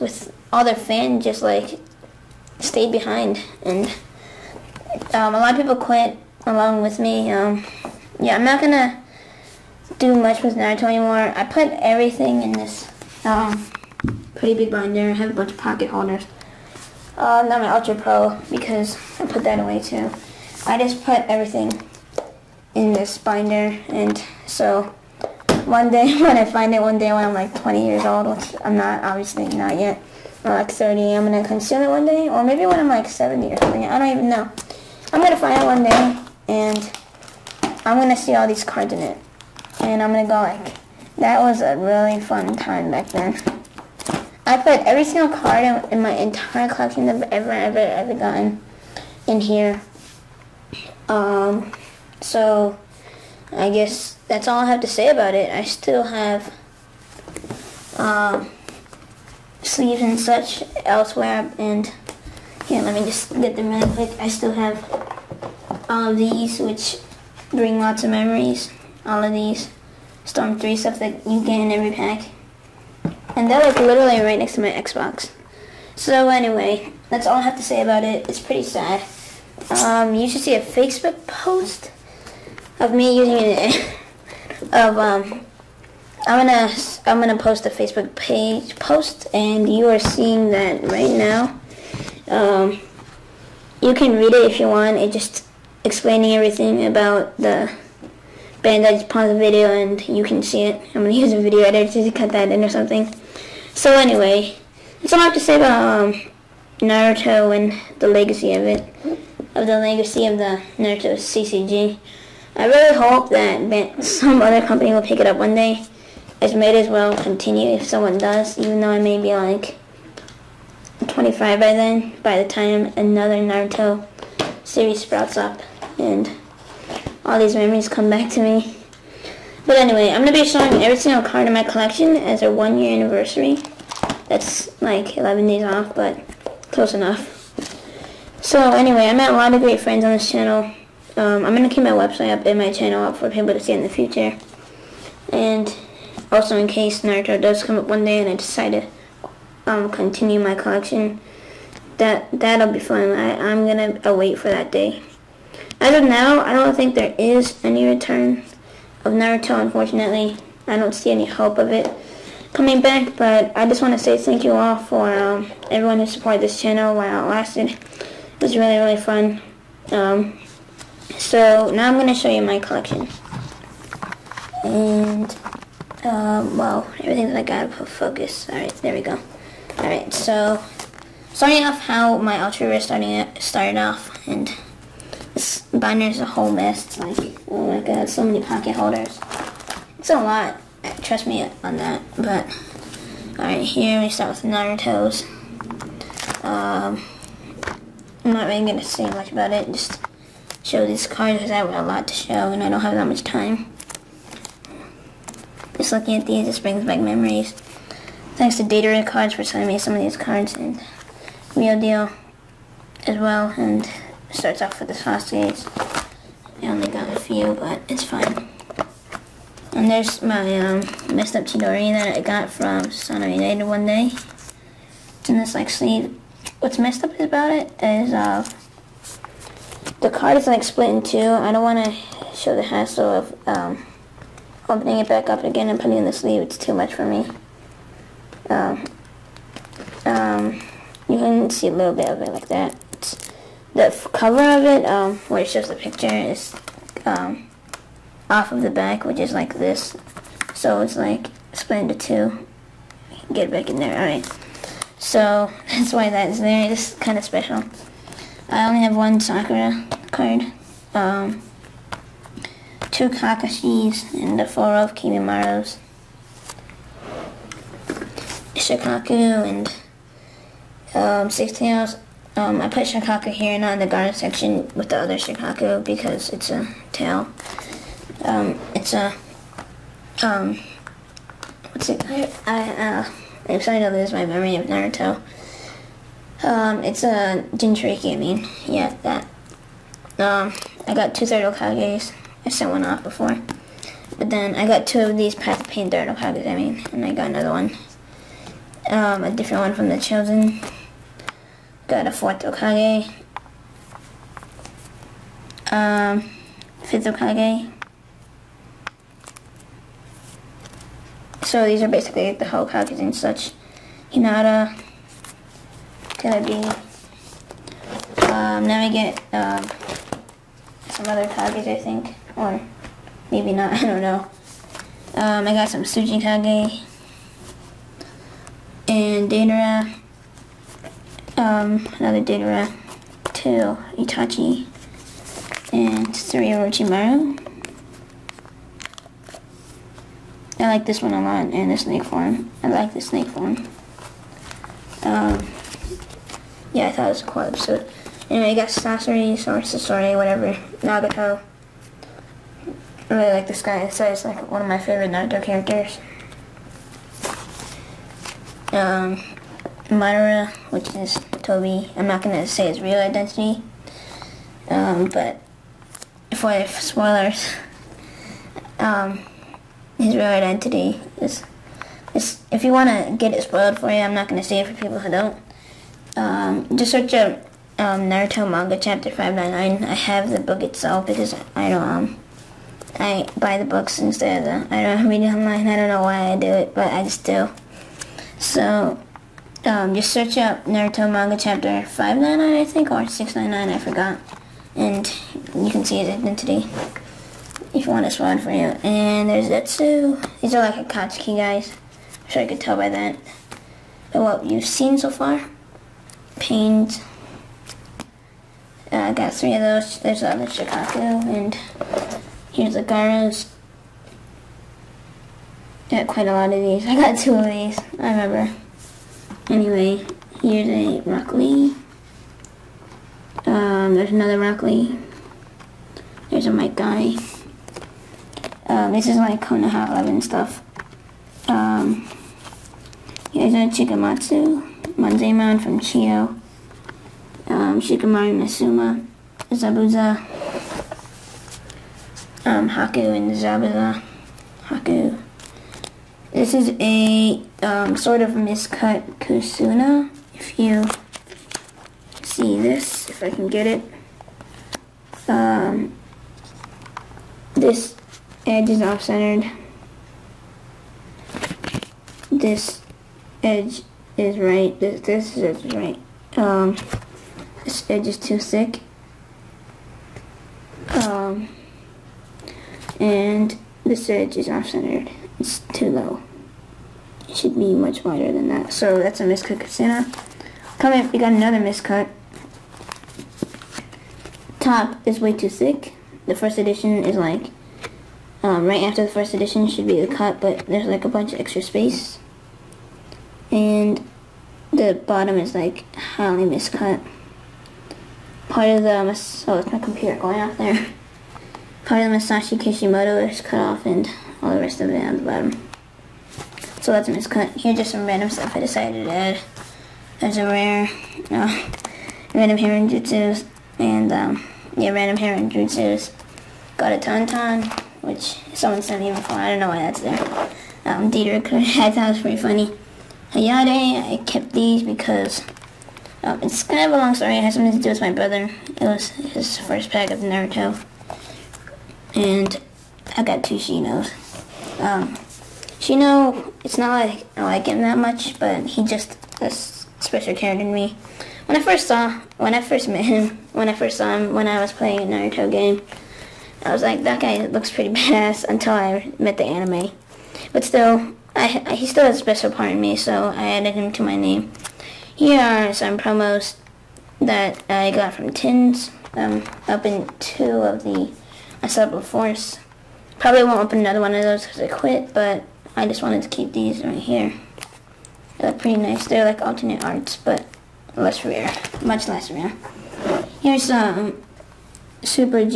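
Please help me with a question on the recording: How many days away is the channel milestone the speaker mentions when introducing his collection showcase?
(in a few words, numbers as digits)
11.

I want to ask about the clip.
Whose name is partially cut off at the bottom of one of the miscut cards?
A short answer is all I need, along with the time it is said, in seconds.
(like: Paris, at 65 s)
Masashi Kishimoto, at 502 s.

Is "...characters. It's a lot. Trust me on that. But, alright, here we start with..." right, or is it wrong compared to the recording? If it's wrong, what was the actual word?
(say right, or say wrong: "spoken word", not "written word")
wrong: "holders", not "characters".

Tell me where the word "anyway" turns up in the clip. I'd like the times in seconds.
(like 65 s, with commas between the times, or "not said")
76 s, 103 s, 129 s, 138 s, 348 s, 419 s.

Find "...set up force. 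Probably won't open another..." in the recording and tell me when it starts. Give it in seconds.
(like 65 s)
561 s.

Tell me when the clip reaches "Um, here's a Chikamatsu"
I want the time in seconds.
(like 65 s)
431 s.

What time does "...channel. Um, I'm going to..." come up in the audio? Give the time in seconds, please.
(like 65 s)
140 s.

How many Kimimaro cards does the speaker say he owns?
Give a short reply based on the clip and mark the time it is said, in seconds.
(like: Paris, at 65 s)
4, at 264 s.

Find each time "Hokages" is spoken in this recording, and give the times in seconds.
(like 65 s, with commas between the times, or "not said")
291 s, 296 s, 302 s, 307 s, 312 s.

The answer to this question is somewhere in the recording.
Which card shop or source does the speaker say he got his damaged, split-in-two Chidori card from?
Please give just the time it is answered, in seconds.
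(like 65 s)
222 s.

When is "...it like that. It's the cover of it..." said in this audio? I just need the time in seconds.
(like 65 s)
242 s.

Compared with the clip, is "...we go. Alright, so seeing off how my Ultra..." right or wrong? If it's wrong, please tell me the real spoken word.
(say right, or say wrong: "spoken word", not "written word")
wrong: "starting", not "seeing".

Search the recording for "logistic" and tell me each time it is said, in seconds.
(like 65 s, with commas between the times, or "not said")
not said.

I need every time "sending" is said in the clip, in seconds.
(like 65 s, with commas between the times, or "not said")
209 s.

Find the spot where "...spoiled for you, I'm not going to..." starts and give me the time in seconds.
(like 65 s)
373 s.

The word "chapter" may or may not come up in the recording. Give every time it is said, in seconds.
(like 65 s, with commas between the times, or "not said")
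378 s, 391 s.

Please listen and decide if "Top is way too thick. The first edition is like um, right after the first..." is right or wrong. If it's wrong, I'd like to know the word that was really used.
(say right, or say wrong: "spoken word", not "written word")
right.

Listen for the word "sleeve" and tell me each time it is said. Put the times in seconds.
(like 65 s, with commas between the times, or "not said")
59 s, 225 s, 236 s.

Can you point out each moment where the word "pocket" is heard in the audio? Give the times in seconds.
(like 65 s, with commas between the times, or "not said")
15 s, 188 s.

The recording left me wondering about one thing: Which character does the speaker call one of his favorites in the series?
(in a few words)
Nagato.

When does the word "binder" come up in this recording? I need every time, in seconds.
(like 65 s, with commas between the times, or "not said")
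14 s, 23 s, 185 s.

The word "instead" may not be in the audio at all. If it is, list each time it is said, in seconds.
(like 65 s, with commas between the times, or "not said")
383 s.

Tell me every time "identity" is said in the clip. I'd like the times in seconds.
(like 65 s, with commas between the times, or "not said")
362 s, 370 s, 396 s.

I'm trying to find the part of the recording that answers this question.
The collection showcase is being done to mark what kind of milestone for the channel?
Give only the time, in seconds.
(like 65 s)
132 s.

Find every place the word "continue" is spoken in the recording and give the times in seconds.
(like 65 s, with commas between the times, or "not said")
117 s, 149 s.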